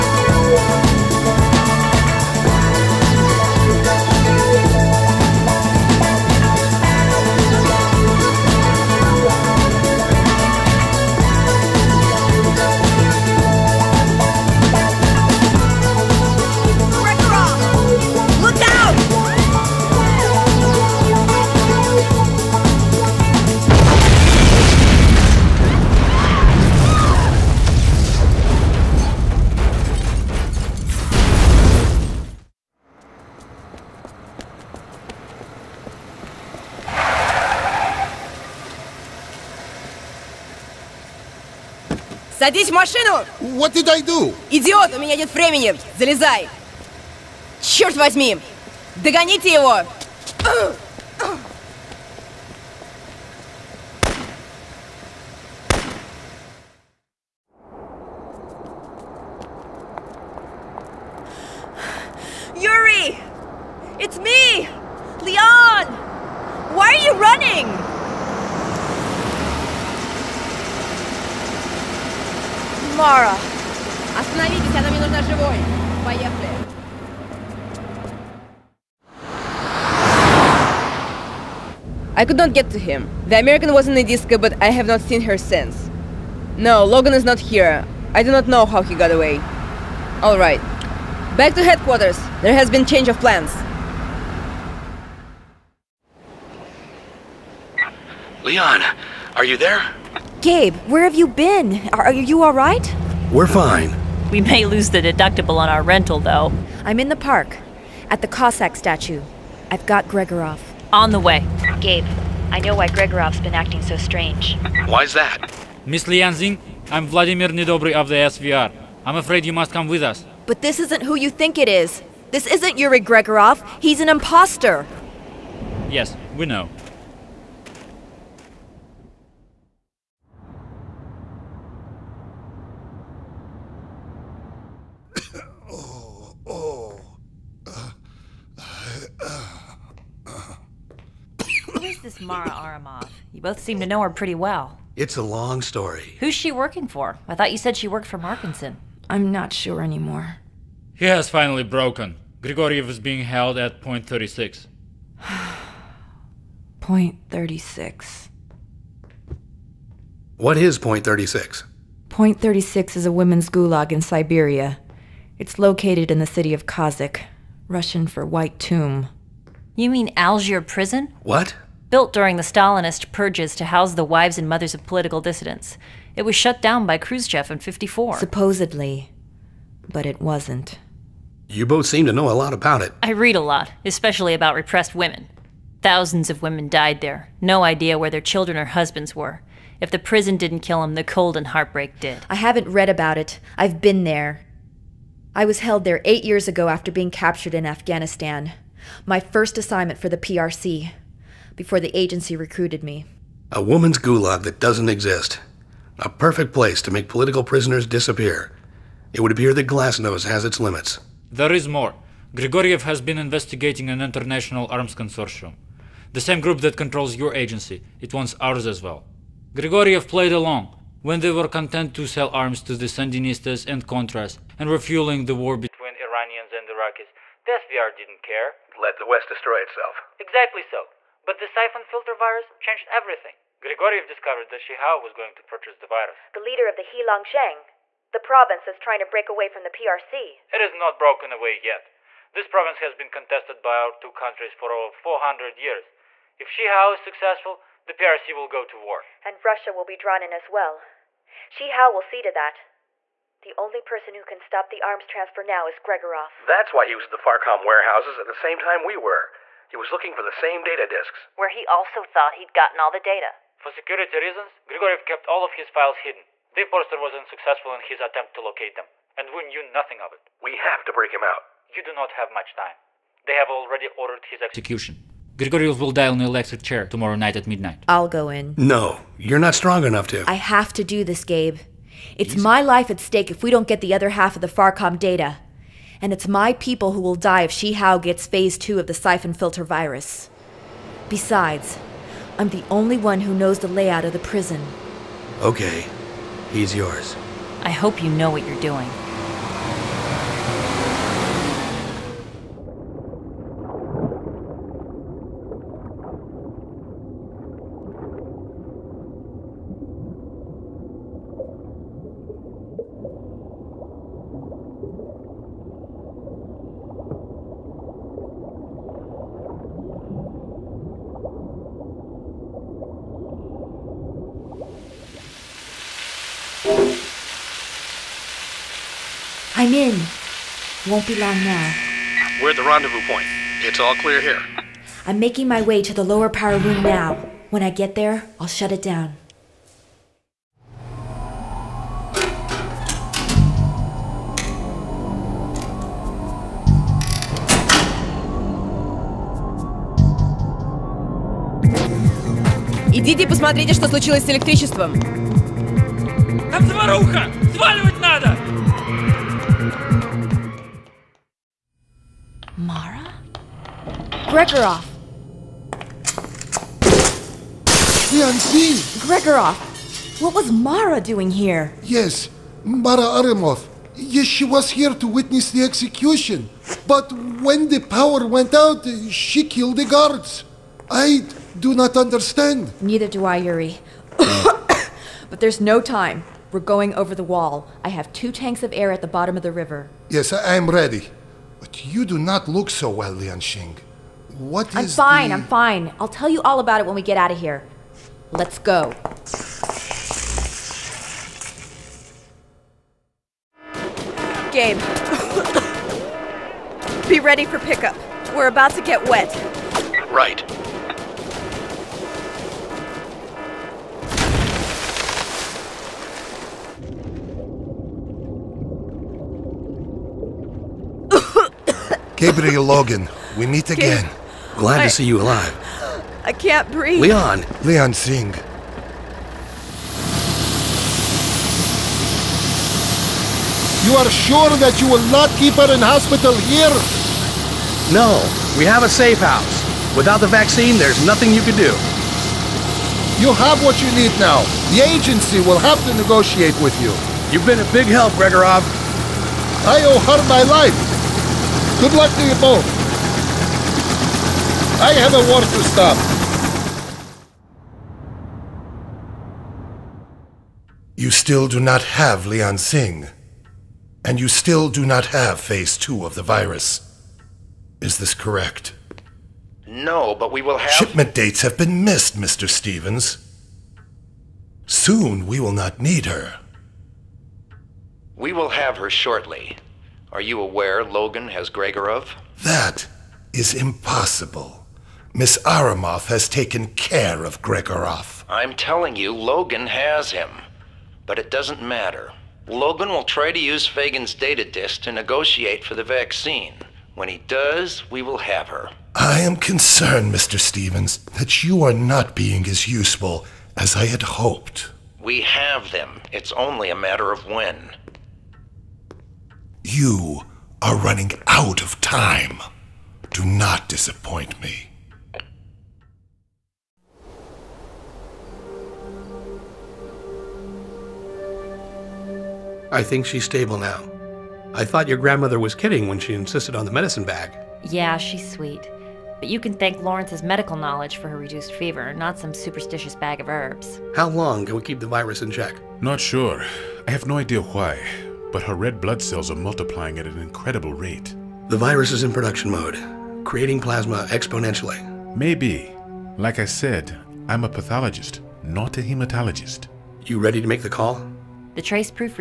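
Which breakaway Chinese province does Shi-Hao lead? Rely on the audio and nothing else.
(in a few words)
Heilongjiang.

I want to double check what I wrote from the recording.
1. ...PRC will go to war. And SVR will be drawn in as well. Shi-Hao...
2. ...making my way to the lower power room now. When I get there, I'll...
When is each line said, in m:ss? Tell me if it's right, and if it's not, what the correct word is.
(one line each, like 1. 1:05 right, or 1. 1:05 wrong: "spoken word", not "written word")
1. 4:07 wrong: "Russia", not "SVR"
2. 5:35 right.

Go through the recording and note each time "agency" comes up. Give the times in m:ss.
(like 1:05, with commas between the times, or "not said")
3:21, 3:37, 7:24.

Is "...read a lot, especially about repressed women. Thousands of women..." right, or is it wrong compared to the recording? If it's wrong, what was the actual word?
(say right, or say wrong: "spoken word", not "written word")
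right.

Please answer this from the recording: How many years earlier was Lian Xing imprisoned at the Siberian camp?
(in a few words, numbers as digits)
8.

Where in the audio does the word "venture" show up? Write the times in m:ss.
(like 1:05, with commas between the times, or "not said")
not said.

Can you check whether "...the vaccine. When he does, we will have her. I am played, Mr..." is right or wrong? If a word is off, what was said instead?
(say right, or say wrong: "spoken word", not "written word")
wrong: "concerned", not "played".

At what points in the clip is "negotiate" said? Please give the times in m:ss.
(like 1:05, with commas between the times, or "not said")
7:26, 8:14.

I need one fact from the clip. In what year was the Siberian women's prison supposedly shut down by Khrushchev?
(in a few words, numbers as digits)
1954.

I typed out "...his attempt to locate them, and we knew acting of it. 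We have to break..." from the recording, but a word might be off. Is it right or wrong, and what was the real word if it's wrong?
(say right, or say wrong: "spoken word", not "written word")
wrong: "nothing", not "acting".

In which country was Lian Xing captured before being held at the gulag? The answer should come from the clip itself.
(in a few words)
Afghanistan.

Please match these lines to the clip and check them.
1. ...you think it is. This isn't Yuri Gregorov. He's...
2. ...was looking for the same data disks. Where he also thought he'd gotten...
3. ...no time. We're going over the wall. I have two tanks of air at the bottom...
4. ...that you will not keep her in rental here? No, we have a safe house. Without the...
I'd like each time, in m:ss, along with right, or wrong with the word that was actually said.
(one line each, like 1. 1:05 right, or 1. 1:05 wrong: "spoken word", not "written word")
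1. 2:01 right
2. 4:19 right
3. 6:25 right
4. 7:14 wrong: "hospital", not "rental".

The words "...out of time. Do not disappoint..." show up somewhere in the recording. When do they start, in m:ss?
8:31.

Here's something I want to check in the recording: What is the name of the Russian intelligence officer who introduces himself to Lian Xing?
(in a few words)
Vladimir Nedobry.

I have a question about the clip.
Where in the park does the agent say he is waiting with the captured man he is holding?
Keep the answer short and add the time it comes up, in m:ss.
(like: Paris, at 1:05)
At the Cossack statue, at 1:48.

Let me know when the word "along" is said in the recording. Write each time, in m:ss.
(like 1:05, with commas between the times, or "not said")
3:40.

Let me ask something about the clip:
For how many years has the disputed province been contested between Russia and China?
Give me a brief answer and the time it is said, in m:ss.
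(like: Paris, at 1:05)
Over 400, at 4:04.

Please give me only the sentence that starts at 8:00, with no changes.
Are you aware Logan has Gregorov?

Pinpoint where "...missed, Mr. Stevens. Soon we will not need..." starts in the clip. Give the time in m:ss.
7:51.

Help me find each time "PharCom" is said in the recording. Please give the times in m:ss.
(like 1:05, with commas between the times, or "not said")
4:17, 4:44.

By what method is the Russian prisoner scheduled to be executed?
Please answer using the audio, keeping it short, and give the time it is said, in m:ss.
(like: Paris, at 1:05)
Electric chair, at 4:36.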